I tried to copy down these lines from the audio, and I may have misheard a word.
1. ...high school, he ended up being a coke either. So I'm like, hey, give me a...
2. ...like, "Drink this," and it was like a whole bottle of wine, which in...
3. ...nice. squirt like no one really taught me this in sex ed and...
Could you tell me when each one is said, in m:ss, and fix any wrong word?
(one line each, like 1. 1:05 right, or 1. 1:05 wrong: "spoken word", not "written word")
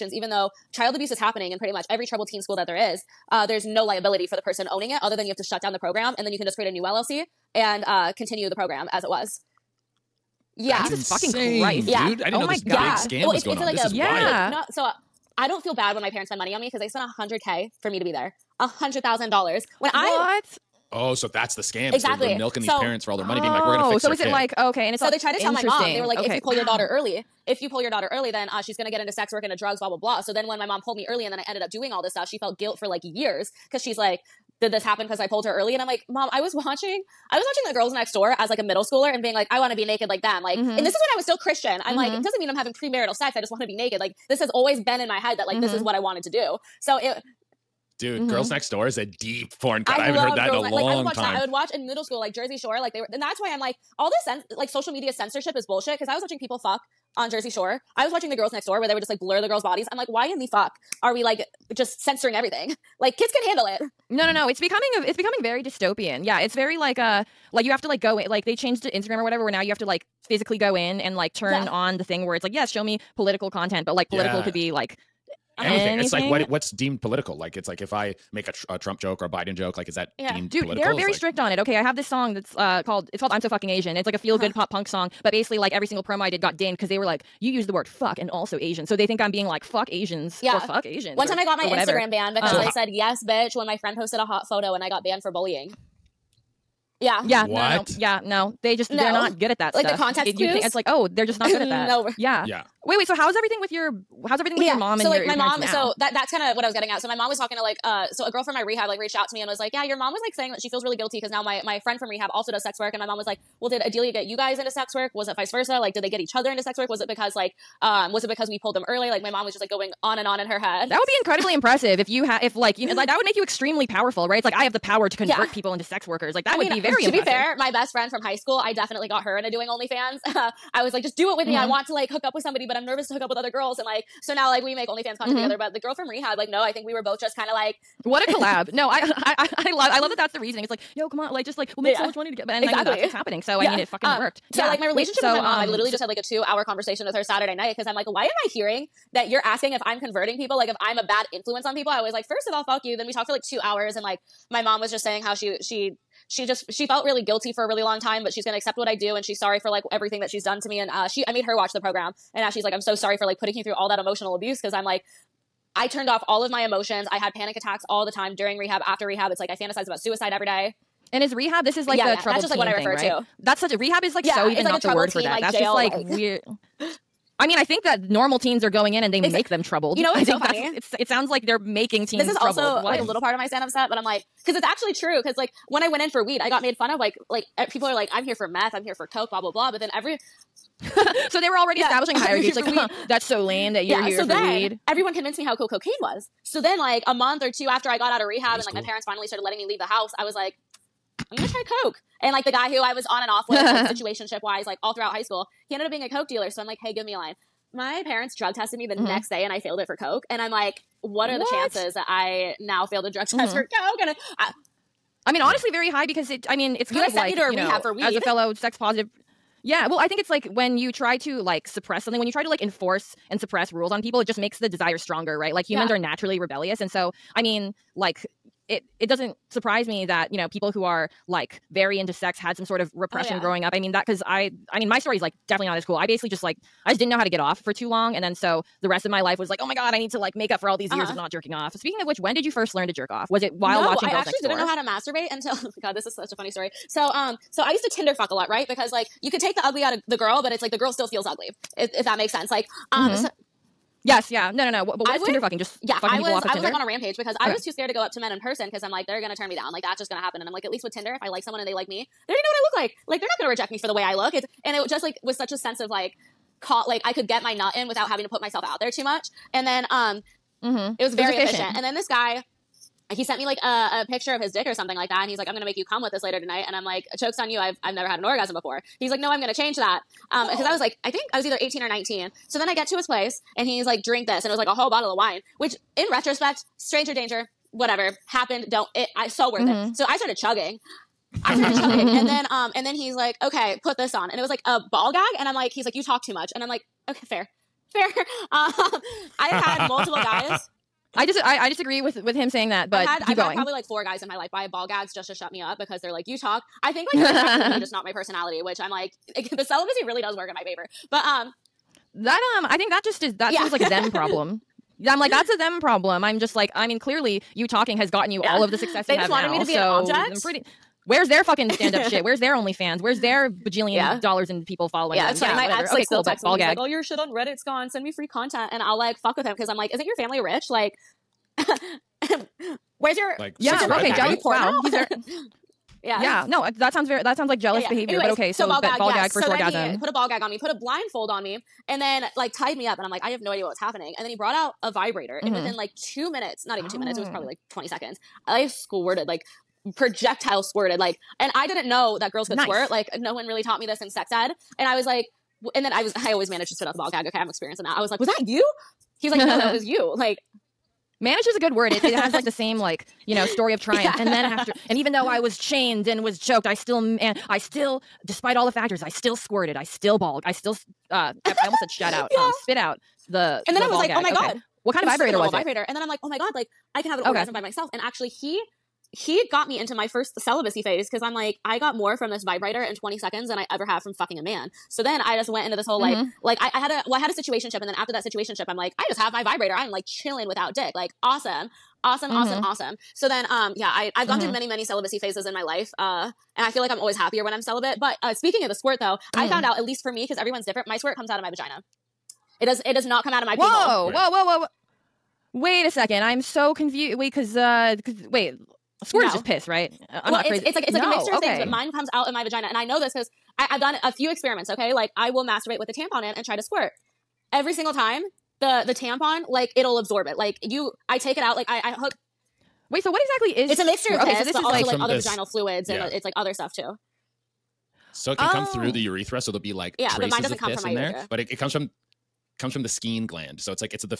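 1. 3:25 wrong: "dealer", not "either"
2. 4:43 right
3. 5:52 right.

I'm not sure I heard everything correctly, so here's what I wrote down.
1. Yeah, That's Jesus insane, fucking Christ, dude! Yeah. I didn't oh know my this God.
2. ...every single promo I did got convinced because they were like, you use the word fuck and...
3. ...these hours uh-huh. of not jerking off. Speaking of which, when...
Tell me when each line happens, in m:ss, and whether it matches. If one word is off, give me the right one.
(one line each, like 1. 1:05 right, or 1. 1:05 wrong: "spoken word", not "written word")
1. 0:10 right
2. 1:25 wrong: "dinged", not "convinced"
3. 4:00 wrong: "years", not "hours".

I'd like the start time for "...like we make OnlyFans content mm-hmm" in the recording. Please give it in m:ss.
2:14.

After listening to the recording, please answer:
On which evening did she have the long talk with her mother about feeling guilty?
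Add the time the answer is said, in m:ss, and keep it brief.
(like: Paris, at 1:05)
Saturday night, at 2:27.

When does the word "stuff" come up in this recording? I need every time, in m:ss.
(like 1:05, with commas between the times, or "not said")
0:32, 7:06.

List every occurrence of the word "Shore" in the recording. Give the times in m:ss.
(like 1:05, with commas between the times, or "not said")
0:52, 0:57.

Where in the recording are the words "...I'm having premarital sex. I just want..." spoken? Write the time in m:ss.
0:42.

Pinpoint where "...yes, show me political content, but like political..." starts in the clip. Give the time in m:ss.
1:12.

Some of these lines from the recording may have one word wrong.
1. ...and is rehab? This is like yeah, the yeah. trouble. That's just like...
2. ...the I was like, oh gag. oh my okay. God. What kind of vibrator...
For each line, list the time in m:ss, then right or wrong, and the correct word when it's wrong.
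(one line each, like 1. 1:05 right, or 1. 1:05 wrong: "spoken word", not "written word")
1. 2:51 right
2. 6:13 right.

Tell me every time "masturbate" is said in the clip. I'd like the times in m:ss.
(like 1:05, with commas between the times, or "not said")
4:04, 6:55.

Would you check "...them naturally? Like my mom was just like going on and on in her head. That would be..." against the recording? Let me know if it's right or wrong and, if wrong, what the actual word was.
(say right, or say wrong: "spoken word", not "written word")
wrong: "early", not "naturally".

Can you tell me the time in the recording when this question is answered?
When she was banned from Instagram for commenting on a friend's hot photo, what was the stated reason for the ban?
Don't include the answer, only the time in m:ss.
1:35.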